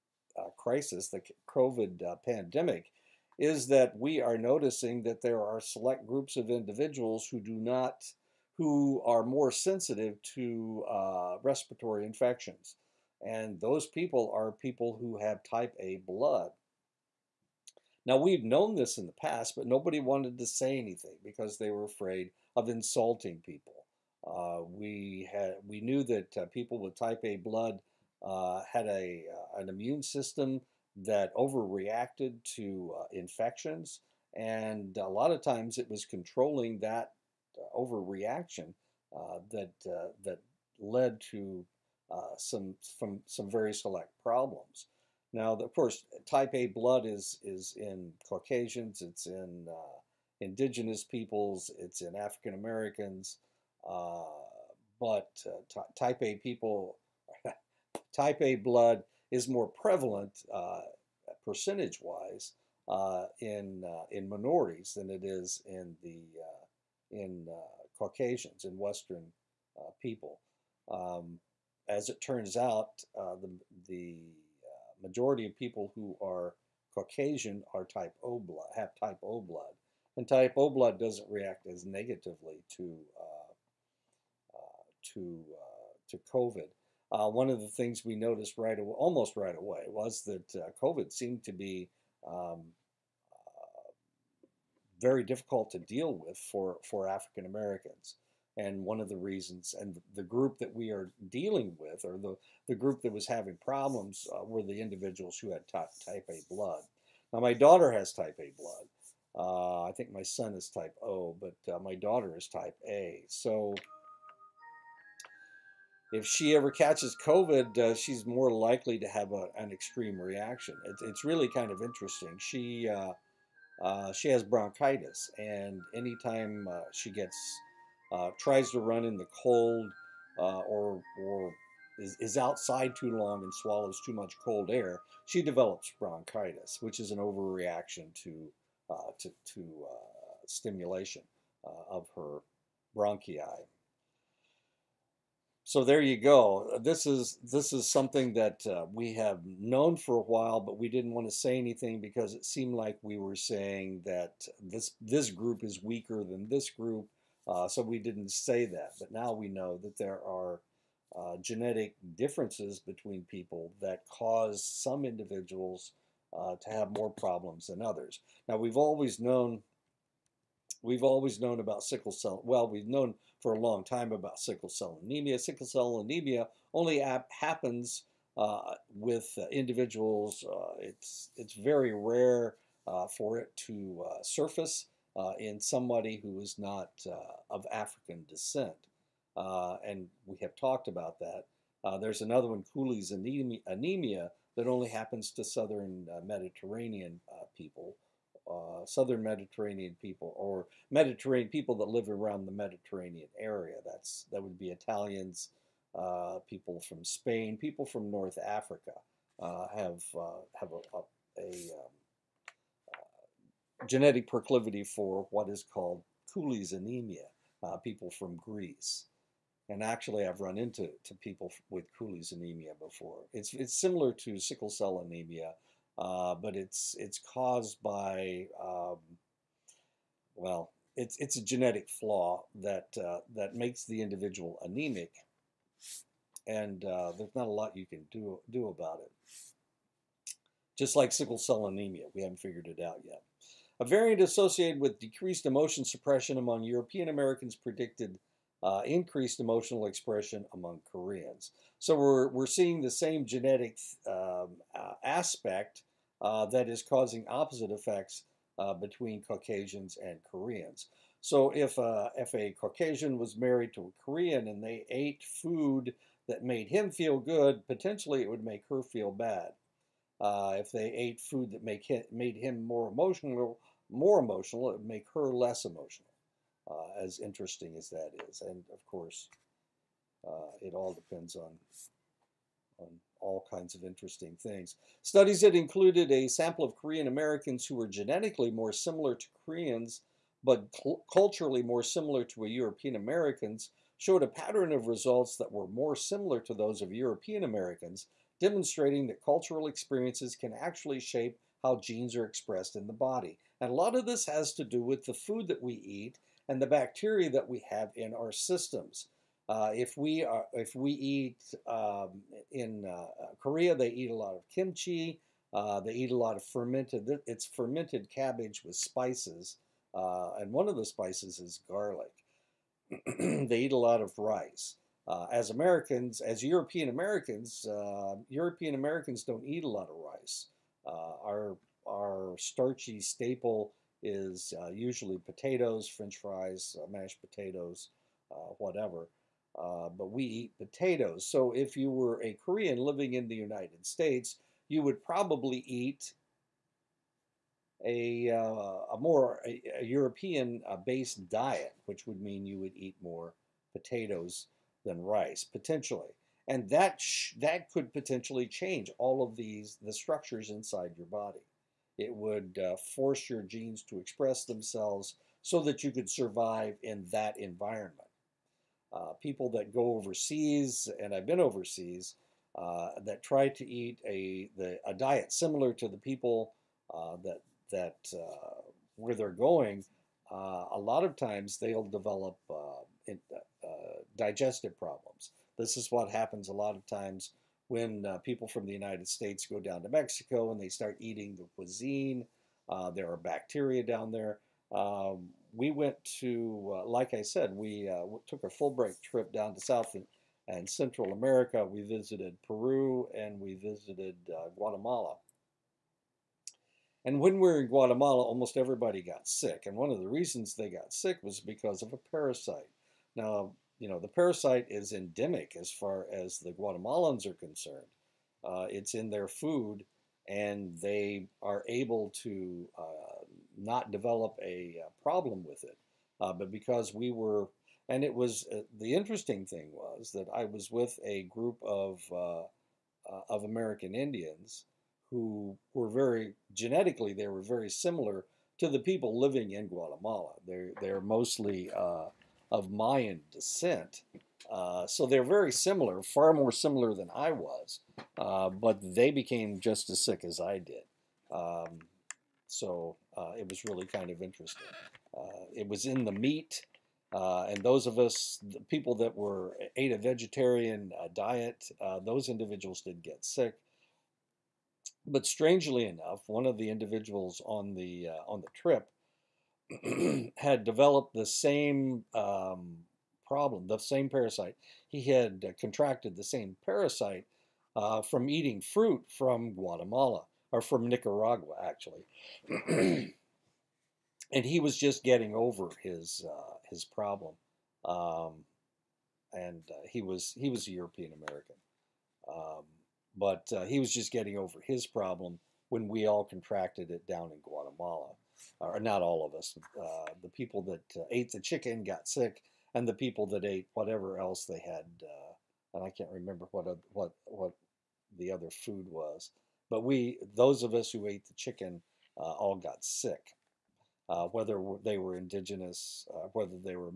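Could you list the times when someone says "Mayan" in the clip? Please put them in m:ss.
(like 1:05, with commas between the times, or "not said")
7:22.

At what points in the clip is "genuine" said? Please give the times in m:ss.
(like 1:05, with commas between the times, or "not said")
not said.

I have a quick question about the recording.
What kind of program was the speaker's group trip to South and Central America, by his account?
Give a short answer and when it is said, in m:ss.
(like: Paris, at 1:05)
Fulbright, at 6:38.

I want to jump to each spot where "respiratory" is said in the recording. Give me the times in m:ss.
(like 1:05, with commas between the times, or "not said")
0:11.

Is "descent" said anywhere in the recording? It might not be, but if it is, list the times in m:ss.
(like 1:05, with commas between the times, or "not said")
3:08, 7:23.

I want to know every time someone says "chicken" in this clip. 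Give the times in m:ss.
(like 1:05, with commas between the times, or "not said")
8:21, 8:31.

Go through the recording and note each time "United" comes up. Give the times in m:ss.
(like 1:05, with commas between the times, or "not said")
5:43, 6:28.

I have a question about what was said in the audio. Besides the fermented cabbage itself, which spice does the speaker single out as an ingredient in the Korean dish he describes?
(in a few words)
garlic.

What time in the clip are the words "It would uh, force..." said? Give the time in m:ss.
6:01.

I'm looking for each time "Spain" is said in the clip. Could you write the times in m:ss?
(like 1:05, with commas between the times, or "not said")
3:27.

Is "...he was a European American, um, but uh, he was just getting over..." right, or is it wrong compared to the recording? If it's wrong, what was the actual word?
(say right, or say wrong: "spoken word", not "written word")
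right.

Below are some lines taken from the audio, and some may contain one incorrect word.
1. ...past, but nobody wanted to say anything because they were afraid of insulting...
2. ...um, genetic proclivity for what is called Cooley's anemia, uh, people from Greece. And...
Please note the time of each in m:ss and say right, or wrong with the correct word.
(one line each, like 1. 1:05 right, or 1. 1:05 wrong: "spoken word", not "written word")
1. 0:19 right
2. 3:31 right.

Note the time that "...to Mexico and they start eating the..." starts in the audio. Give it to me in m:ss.
6:29.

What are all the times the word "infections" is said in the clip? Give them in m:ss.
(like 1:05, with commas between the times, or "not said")
0:12, 0:33.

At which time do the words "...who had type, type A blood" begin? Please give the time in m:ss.
1:45.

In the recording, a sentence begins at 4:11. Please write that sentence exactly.
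So we're, we're seeing the same genetic uh, aspect uh, that is causing opposite effects uh, between Caucasians and Koreans.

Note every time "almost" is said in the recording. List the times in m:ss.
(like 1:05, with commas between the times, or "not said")
1:28, 6:48.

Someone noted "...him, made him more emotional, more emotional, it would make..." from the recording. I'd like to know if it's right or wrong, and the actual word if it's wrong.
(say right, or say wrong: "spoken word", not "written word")
right.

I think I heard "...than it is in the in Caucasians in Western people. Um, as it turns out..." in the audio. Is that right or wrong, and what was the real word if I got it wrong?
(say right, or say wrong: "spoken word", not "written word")
right.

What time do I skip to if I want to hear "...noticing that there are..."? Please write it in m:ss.
0:04.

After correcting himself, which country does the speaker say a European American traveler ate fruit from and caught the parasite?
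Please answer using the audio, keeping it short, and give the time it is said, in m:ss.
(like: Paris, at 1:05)
Nicaragua, at 8:00.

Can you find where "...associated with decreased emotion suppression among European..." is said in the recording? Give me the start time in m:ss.
4:04.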